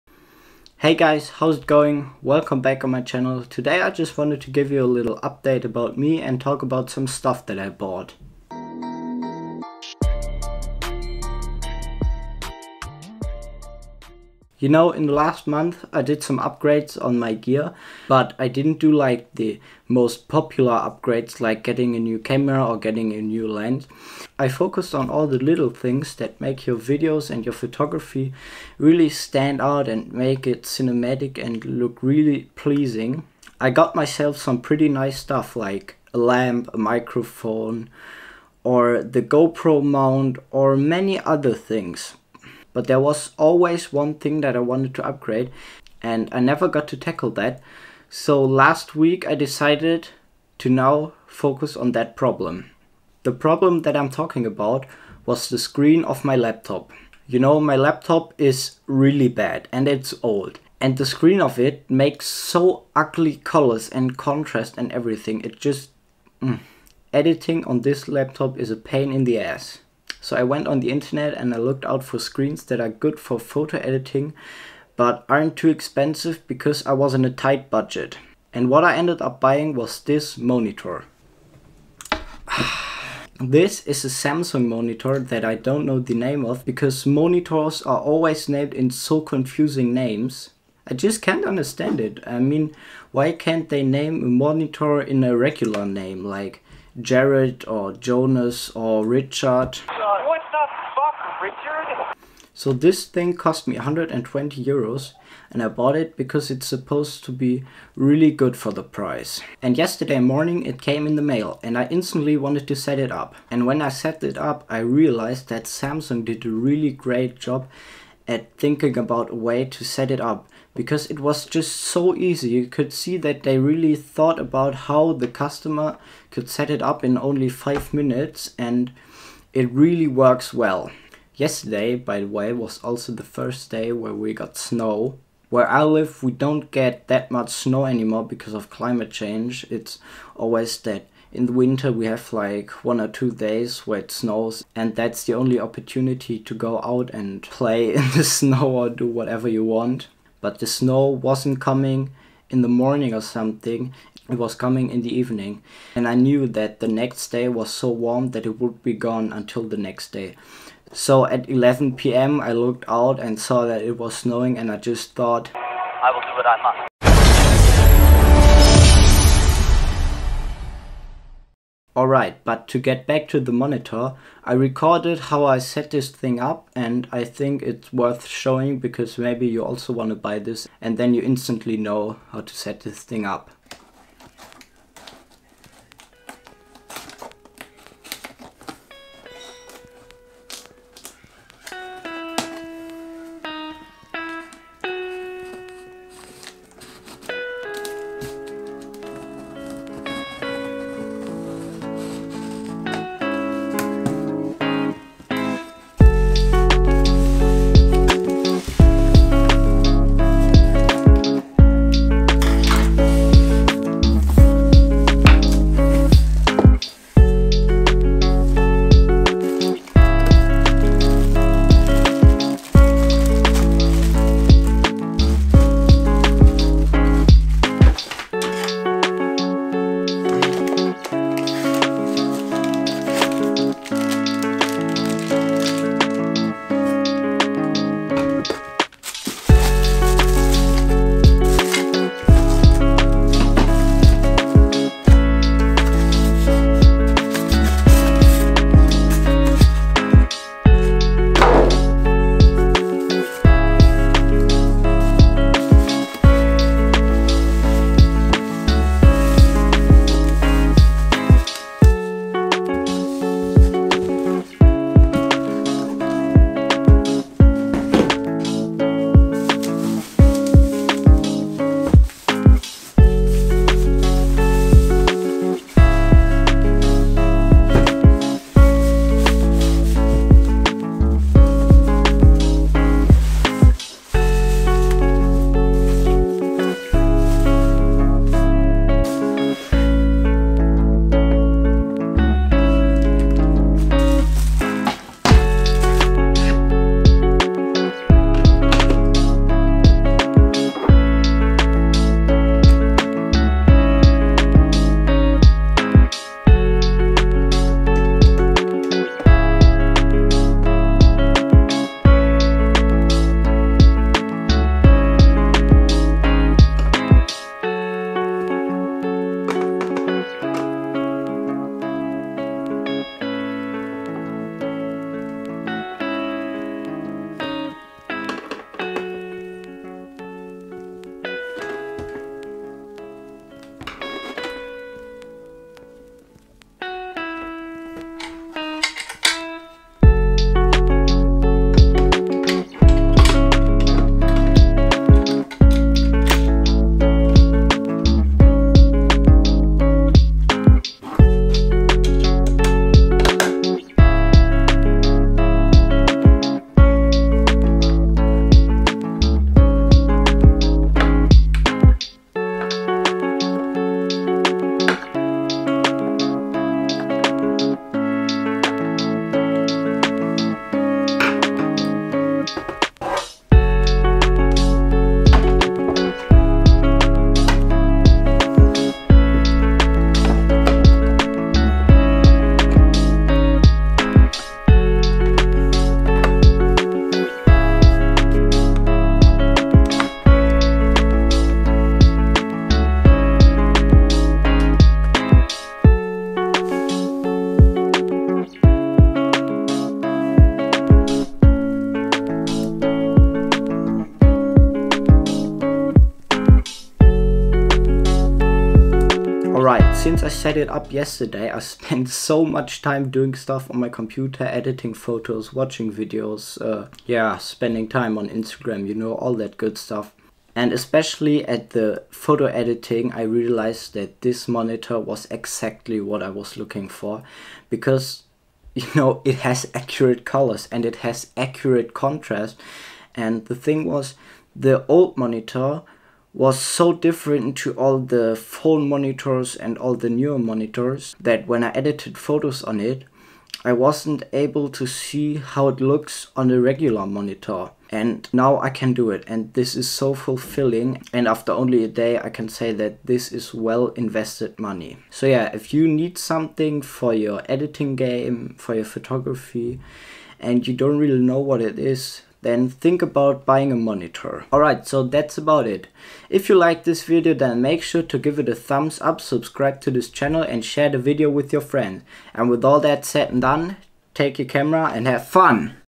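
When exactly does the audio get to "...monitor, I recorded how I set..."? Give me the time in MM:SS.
02:53.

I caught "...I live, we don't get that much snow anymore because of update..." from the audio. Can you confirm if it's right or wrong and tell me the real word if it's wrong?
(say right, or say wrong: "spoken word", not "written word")
wrong: "climate", not "update".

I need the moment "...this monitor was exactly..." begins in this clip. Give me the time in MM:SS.
07:04.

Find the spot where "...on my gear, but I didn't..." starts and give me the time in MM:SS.
00:17.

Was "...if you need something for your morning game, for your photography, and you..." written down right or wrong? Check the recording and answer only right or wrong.
wrong.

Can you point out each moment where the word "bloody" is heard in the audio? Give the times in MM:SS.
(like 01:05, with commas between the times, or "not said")
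not said.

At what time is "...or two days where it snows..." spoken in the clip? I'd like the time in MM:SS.
02:23.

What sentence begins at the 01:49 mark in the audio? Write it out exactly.
And yesterday morning it came in the mail and I instantly wanted to set it up.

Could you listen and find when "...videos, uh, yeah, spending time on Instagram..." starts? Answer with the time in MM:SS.
06:55.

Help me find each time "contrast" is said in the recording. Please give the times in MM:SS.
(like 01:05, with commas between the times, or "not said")
01:04, 07:11.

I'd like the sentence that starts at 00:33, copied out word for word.
I got myself some pretty nice stuff like a lamp, a microphone, or the GoPro mount or many other things.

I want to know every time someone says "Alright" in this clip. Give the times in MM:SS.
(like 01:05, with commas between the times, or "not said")
02:51, 07:44.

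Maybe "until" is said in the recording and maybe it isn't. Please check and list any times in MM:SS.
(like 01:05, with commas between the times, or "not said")
02:39.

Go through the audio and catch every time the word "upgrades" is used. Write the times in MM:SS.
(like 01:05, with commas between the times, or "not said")
00:16, 00:20, 00:45.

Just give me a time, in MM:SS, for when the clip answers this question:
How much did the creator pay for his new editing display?
01:43.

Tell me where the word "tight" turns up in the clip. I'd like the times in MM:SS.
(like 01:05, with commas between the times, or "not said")
01:17.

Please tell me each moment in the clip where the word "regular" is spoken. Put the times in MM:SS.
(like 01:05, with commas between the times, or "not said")
01:35, 07:26.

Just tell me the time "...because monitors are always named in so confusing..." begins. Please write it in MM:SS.
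01:26.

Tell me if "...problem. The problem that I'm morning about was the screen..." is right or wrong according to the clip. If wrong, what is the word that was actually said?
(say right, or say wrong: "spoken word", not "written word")
wrong: "talking", not "morning".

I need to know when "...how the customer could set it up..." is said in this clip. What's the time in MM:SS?
02:04.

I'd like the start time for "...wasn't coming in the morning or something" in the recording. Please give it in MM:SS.
02:31.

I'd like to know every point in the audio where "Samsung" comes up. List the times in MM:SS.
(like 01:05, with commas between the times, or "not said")
01:24, 01:55.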